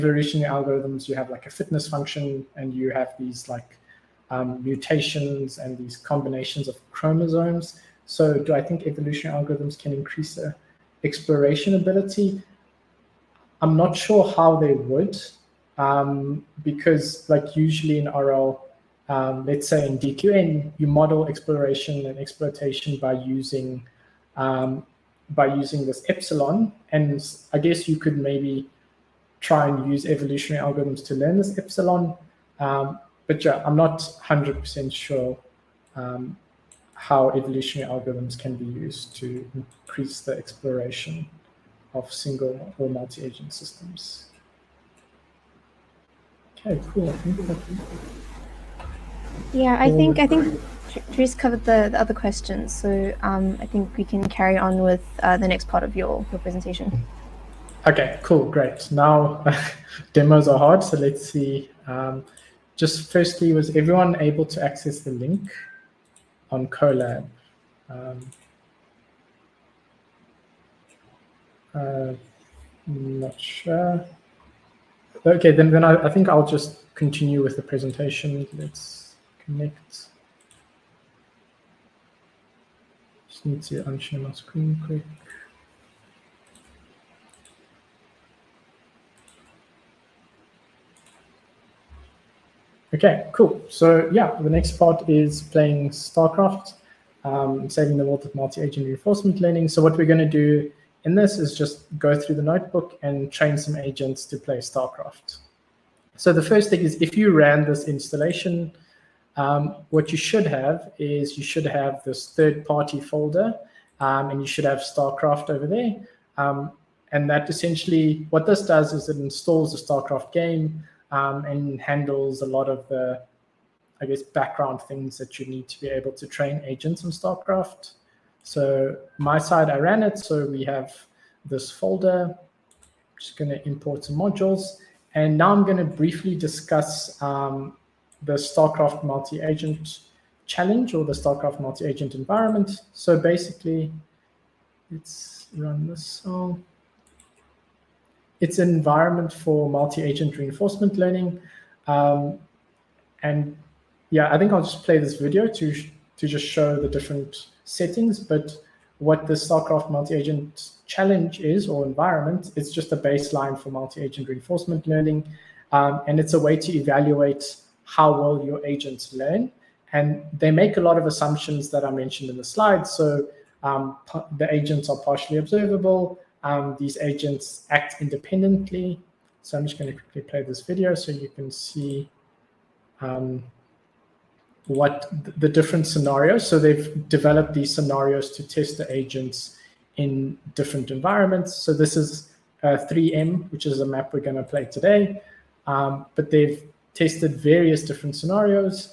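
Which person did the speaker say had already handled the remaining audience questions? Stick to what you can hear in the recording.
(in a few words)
Dries.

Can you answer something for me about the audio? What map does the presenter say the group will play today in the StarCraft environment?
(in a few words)
3M.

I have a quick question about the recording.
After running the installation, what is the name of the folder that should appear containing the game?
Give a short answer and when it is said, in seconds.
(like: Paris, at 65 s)
third party folder, at 112 s.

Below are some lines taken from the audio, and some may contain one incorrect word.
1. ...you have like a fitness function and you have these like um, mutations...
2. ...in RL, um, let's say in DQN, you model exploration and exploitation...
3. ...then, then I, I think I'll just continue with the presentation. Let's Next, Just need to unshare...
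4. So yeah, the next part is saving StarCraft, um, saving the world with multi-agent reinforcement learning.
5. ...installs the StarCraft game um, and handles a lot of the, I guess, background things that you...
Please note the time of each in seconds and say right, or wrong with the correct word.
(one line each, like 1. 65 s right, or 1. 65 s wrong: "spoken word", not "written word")
1. 1 s right
2. 17 s right
3. 75 s right
4. 93 s wrong: "playing", not "saving"
5. 119 s right.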